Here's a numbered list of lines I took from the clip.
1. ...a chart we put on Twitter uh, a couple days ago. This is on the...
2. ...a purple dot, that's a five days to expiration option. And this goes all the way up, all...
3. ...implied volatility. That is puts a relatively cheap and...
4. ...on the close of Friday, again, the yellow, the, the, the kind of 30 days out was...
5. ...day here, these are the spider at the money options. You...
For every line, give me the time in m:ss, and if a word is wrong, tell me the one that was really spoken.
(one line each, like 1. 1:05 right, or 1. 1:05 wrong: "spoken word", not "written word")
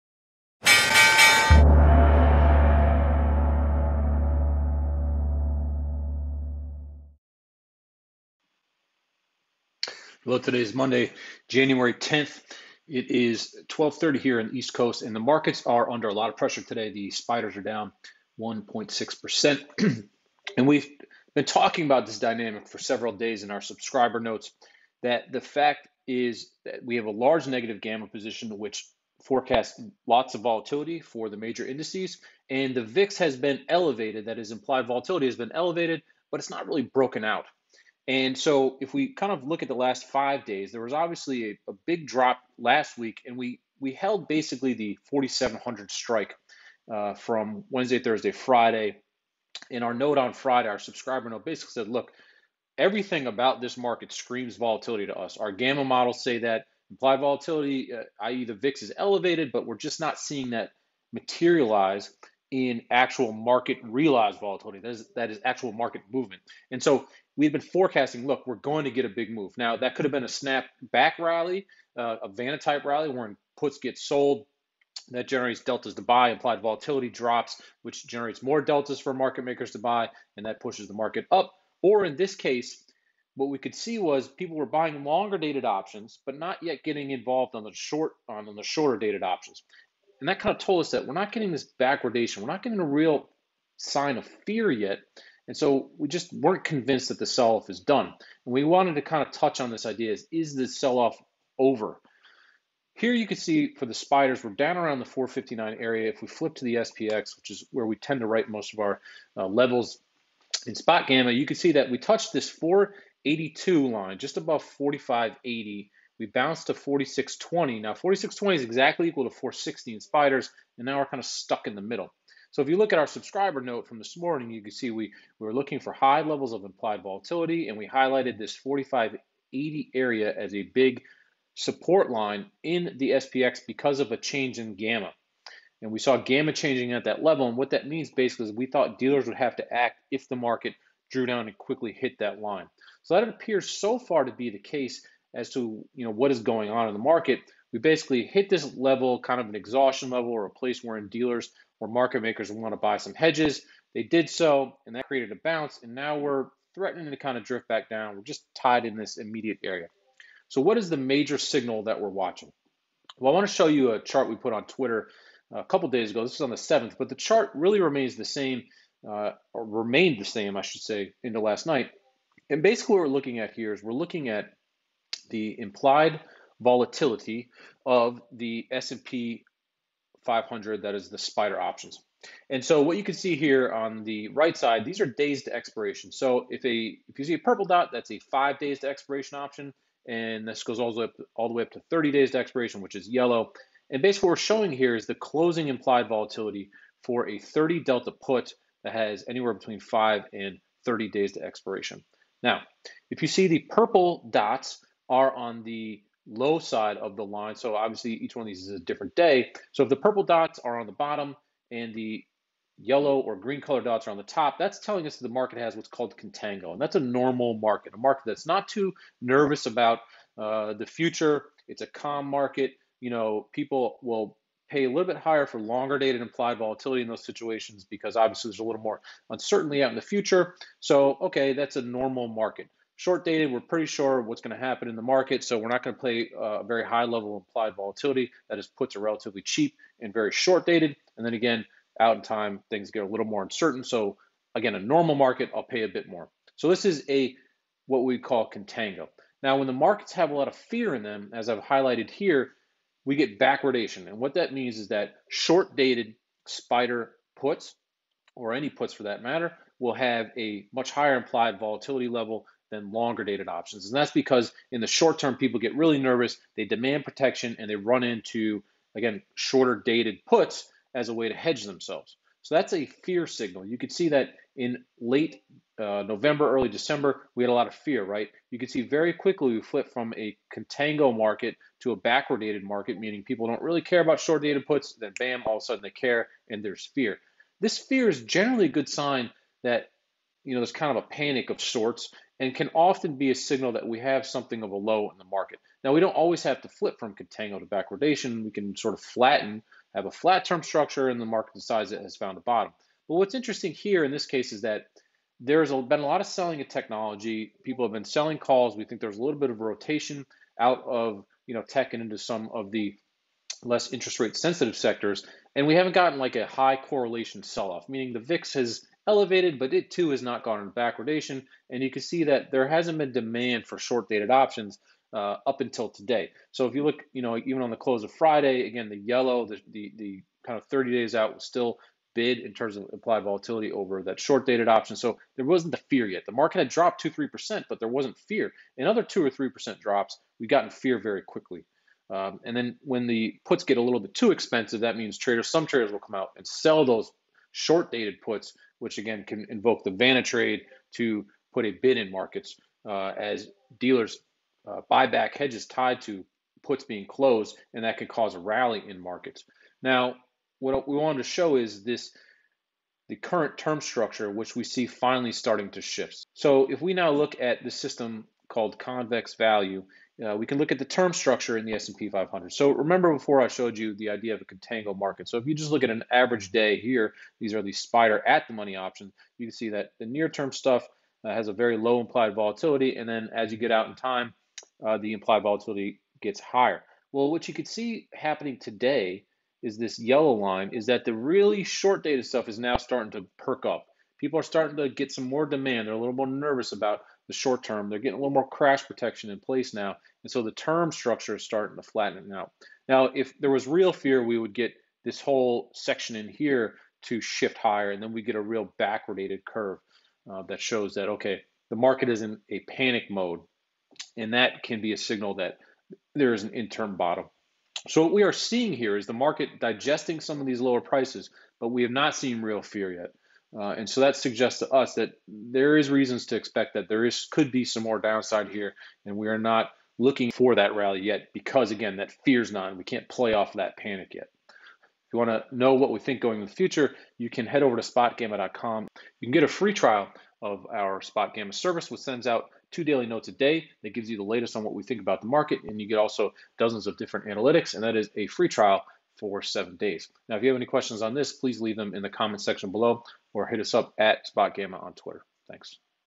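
1. 2:43 right
2. 3:07 right
3. 3:57 right
4. 5:27 right
5. 6:16 right.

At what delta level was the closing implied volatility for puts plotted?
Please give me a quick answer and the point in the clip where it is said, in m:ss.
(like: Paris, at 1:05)
30 delta, at 3:17.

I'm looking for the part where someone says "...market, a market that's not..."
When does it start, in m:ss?
3:37.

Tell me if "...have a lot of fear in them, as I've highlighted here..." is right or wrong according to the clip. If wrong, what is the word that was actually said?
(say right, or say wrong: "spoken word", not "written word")
right.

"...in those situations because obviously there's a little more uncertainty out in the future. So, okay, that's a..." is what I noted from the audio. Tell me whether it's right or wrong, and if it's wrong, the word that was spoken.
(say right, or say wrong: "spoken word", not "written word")
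right.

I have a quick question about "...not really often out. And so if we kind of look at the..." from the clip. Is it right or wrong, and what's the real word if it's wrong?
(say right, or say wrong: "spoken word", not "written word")
wrong: "broken", not "often".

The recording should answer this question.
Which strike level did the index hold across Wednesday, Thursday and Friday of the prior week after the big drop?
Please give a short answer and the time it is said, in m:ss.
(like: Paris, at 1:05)
4,700, at 0:45.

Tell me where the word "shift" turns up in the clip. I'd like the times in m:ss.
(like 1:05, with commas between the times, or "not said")
6:05, 6:47.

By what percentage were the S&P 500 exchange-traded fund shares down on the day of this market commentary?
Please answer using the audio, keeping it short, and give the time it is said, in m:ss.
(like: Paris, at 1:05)
1.6%, at 0:18.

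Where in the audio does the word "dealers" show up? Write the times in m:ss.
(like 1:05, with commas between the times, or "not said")
2:18, 2:31, 5:53.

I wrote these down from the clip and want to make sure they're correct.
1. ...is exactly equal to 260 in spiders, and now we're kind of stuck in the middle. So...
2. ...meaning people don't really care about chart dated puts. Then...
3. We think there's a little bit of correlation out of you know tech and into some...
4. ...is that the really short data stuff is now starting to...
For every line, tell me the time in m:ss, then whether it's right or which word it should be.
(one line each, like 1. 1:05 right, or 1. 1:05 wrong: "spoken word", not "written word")
1. 1:58 wrong: "460", not "260"
2. 4:42 wrong: "short", not "chart"
3. 5:08 wrong: "rotation", not "correlation"
4. 6:30 right.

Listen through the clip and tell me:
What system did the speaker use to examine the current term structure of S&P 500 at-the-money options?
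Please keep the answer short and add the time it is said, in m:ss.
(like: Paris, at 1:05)
ConvexValue, at 6:08.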